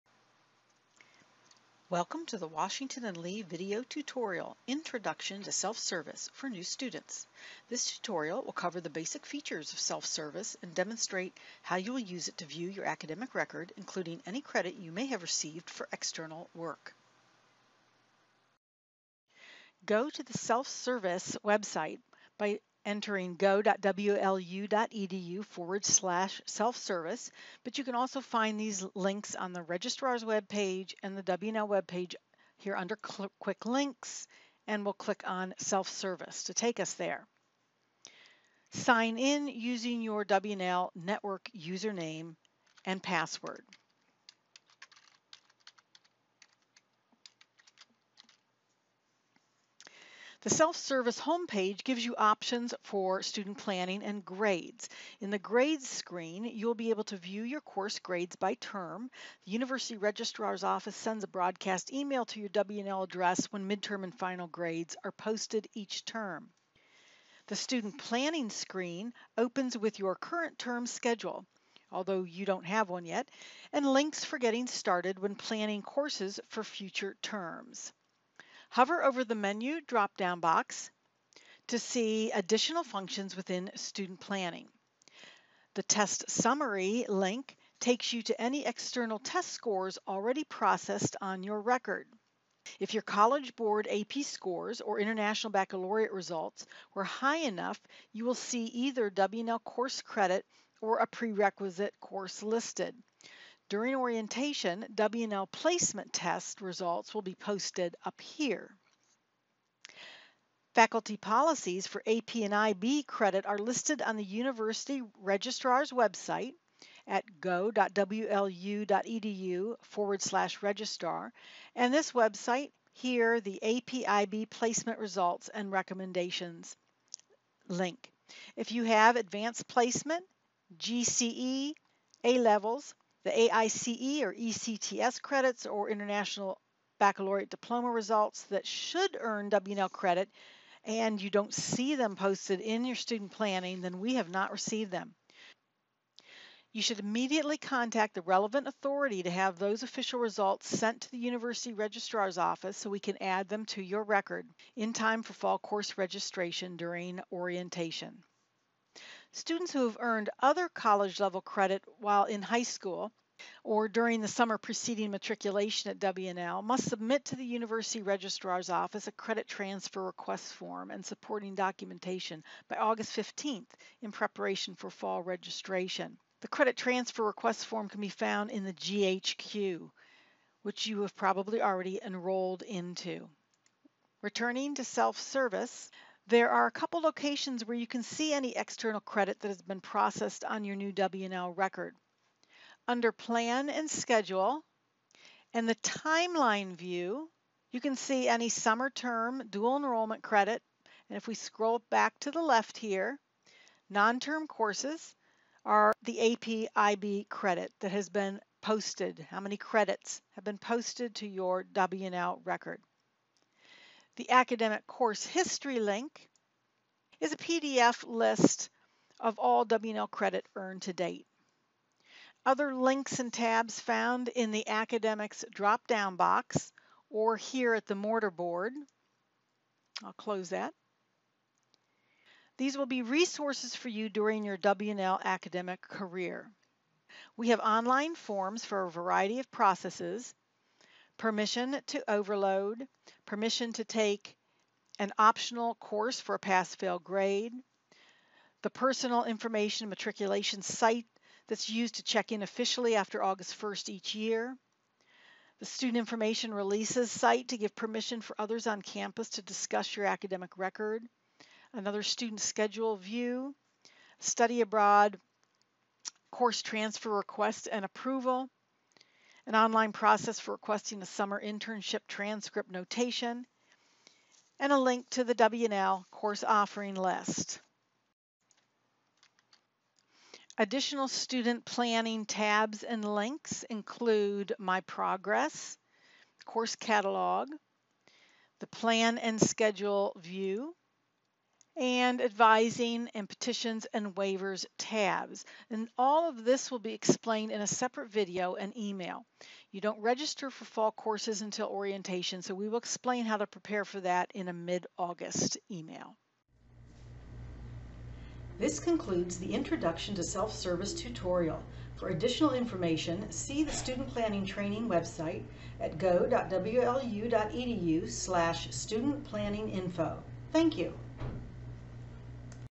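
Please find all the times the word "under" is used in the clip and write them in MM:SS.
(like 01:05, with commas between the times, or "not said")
00:32, 03:12.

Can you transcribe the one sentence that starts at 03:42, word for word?
Other links and tabs found in the academics drop-down box or here at the mortar board.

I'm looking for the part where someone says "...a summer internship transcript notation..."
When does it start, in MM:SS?
04:31.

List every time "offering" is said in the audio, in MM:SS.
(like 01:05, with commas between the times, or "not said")
04:36.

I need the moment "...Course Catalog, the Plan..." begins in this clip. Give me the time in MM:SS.
04:46.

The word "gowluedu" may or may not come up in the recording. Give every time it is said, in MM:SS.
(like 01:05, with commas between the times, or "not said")
00:23, 01:57, 05:15.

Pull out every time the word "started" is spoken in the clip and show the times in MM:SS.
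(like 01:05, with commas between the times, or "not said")
01:14.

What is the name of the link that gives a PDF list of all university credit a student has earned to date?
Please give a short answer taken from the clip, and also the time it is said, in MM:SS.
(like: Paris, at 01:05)
academic course history, at 03:34.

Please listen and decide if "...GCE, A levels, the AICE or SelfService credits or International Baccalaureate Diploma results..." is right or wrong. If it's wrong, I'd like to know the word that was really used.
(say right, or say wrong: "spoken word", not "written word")
wrong: "ECTS", not "SelfService".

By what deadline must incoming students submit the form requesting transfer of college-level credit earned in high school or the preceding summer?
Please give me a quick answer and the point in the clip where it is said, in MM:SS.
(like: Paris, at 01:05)
August 15th, at 02:52.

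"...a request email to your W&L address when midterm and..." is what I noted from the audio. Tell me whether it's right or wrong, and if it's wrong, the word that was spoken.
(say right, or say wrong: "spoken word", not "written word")
wrong: "broadcast", not "request".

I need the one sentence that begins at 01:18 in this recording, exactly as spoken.
Hover over the menu drop-down box to see additional functions within student planning.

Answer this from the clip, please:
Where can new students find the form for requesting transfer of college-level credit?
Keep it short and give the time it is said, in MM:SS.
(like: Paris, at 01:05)
the GHQ, at 02:58.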